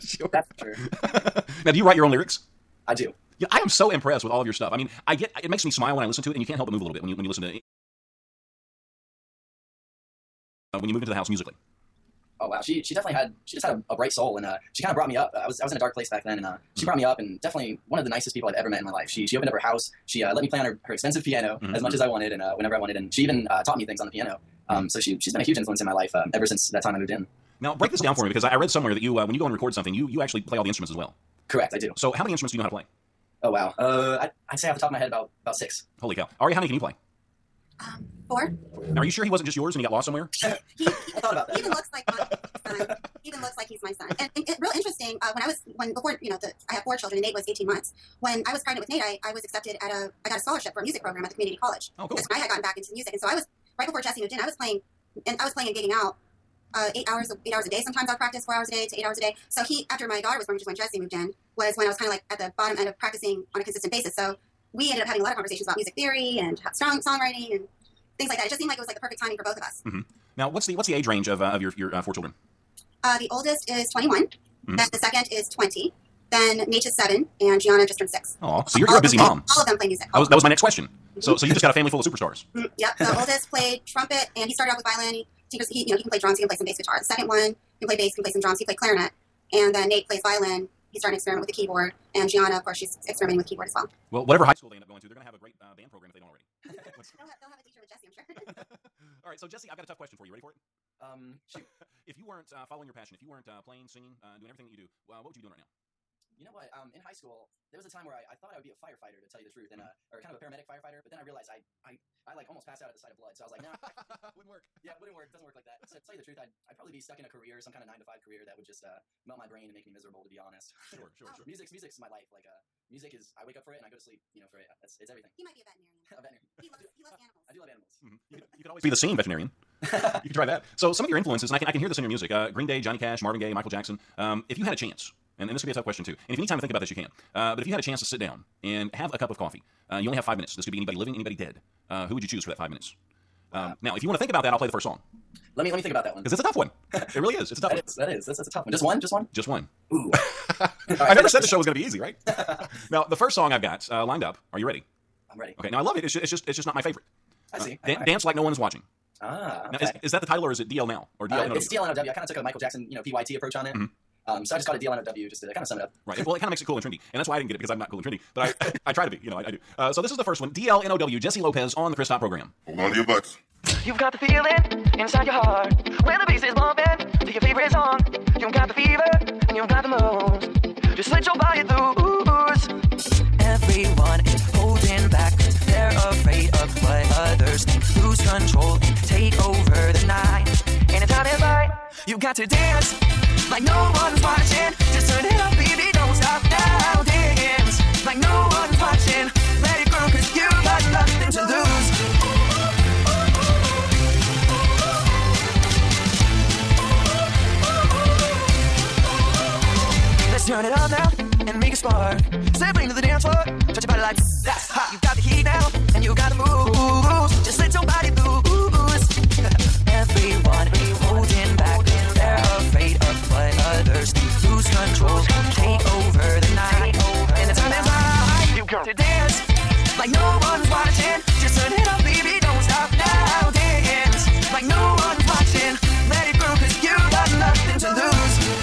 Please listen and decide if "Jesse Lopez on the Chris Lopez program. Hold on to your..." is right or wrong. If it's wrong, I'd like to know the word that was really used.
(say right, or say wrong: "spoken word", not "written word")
wrong: "Top", not "Lopez".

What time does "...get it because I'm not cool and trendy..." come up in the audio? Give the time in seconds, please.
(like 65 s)
167 s.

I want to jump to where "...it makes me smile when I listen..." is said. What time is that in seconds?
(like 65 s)
5 s.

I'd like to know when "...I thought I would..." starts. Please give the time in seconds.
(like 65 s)
108 s.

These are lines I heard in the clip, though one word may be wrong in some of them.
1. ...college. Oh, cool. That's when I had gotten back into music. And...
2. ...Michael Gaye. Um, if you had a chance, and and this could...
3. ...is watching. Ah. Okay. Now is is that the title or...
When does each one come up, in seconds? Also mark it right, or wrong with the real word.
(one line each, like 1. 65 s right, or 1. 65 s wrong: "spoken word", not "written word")
1. 51 s right
2. 133 s wrong: "Jackson", not "Gaye"
3. 158 s right.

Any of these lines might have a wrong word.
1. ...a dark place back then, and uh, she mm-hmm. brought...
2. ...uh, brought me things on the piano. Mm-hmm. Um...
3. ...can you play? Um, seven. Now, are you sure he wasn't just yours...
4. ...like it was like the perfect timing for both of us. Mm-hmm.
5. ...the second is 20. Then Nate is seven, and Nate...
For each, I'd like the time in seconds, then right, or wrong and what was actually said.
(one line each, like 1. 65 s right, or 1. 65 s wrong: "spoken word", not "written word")
1. 15 s right
2. 23 s wrong: "taught", not "brought"
3. 36 s wrong: "four", not "seven"
4. 68 s right
5. 74 s wrong: "Gianna", not "Nate".